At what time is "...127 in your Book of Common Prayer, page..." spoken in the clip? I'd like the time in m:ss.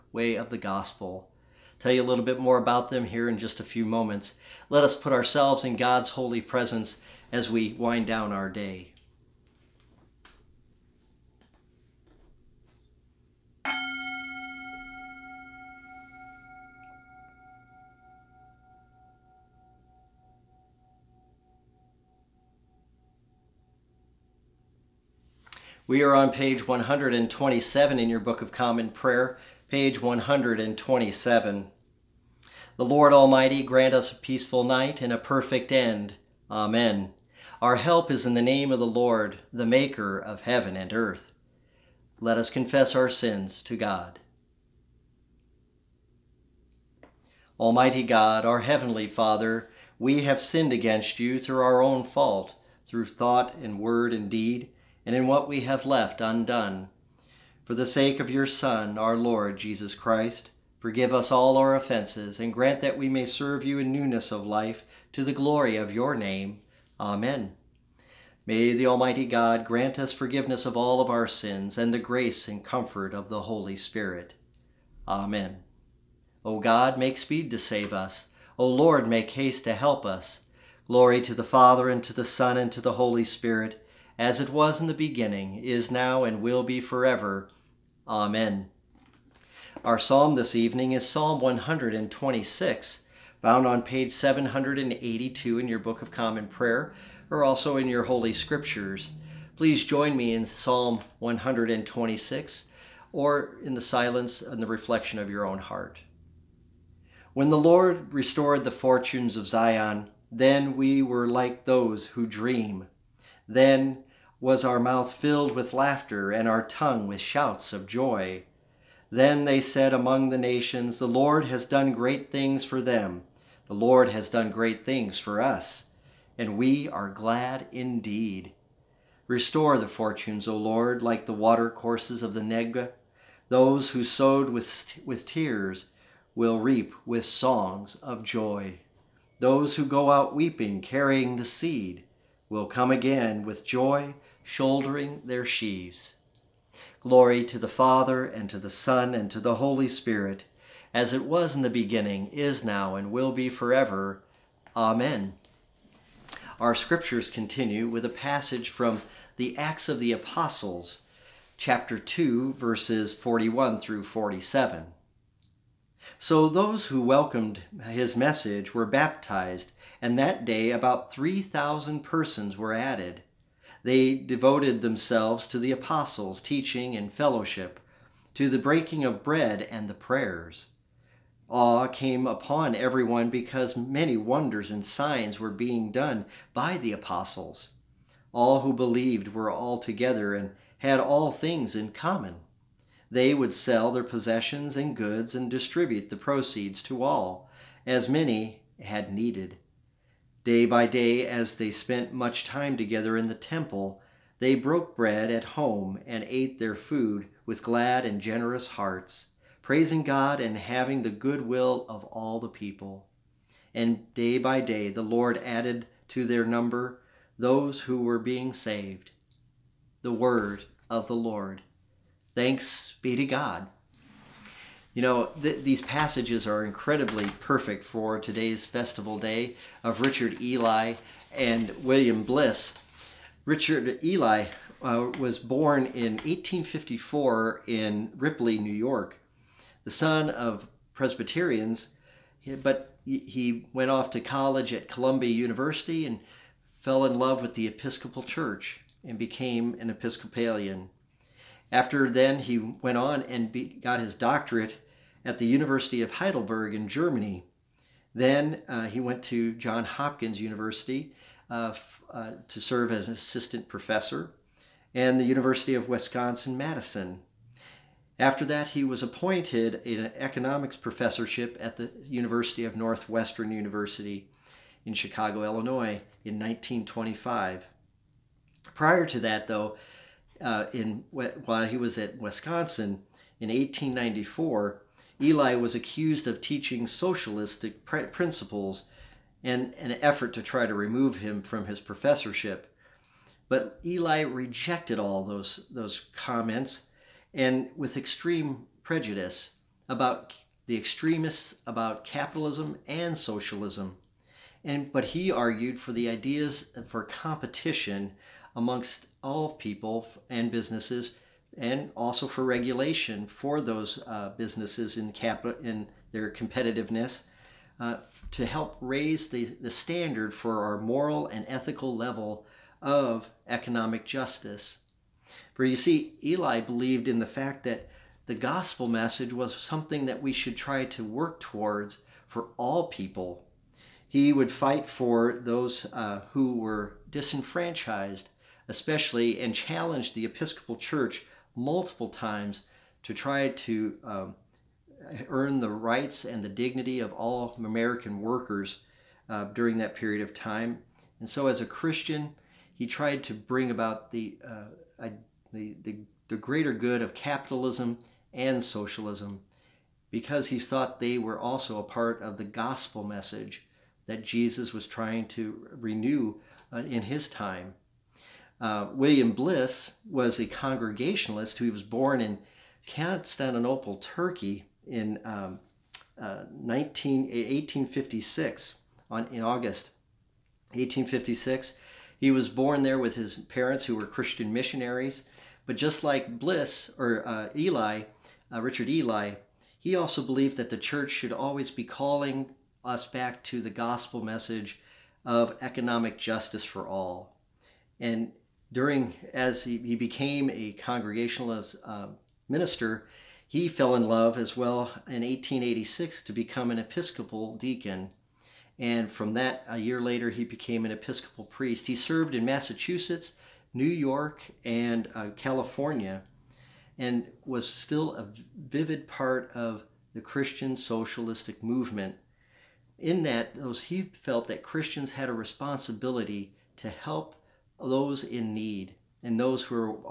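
0:26.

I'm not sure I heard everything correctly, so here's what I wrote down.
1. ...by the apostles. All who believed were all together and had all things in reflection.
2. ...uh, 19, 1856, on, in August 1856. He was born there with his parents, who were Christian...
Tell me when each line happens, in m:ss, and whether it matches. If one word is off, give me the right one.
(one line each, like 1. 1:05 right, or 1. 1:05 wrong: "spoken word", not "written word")
1. 3:06 wrong: "common", not "reflection"
2. 6:16 right.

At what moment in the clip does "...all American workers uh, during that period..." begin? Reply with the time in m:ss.
5:47.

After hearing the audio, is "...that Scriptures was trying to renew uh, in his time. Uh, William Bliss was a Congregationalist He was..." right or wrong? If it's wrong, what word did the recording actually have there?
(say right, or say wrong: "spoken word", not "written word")
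wrong: "Jesus", not "Scriptures".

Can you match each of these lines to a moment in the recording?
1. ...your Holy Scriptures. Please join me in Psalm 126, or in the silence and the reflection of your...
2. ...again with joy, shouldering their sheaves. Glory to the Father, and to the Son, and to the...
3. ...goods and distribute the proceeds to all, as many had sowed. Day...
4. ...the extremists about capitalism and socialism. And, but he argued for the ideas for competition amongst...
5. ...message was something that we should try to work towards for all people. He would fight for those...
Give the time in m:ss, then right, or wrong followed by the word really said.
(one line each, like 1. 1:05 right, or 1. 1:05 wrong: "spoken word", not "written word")
1. 1:37 right
2. 2:22 right
3. 3:14 wrong: "needed", not "sowed"
4. 5:00 right
5. 5:28 right.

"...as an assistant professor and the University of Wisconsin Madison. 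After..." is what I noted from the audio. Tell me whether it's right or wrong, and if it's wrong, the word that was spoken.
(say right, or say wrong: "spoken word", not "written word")
right.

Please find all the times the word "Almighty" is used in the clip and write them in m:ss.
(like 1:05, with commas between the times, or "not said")
0:33, 0:47, 1:08.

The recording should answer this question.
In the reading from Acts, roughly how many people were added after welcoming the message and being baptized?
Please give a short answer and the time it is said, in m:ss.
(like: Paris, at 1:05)
3,000, at 2:51.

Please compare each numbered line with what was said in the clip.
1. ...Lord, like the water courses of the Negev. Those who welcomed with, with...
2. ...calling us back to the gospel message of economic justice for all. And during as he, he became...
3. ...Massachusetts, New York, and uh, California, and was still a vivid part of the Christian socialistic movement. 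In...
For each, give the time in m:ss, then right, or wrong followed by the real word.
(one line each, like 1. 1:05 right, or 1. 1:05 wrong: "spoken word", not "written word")
1. 2:10 wrong: "sowed", not "welcomed"
2. 6:31 right
3. 6:52 right.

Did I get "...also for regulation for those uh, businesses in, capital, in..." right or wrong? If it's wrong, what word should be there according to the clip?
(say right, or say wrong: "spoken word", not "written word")
right.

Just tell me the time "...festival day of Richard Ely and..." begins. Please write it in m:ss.
3:48.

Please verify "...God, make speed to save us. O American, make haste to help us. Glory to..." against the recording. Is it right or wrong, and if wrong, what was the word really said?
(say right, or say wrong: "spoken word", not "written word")
wrong: "Lord", not "American".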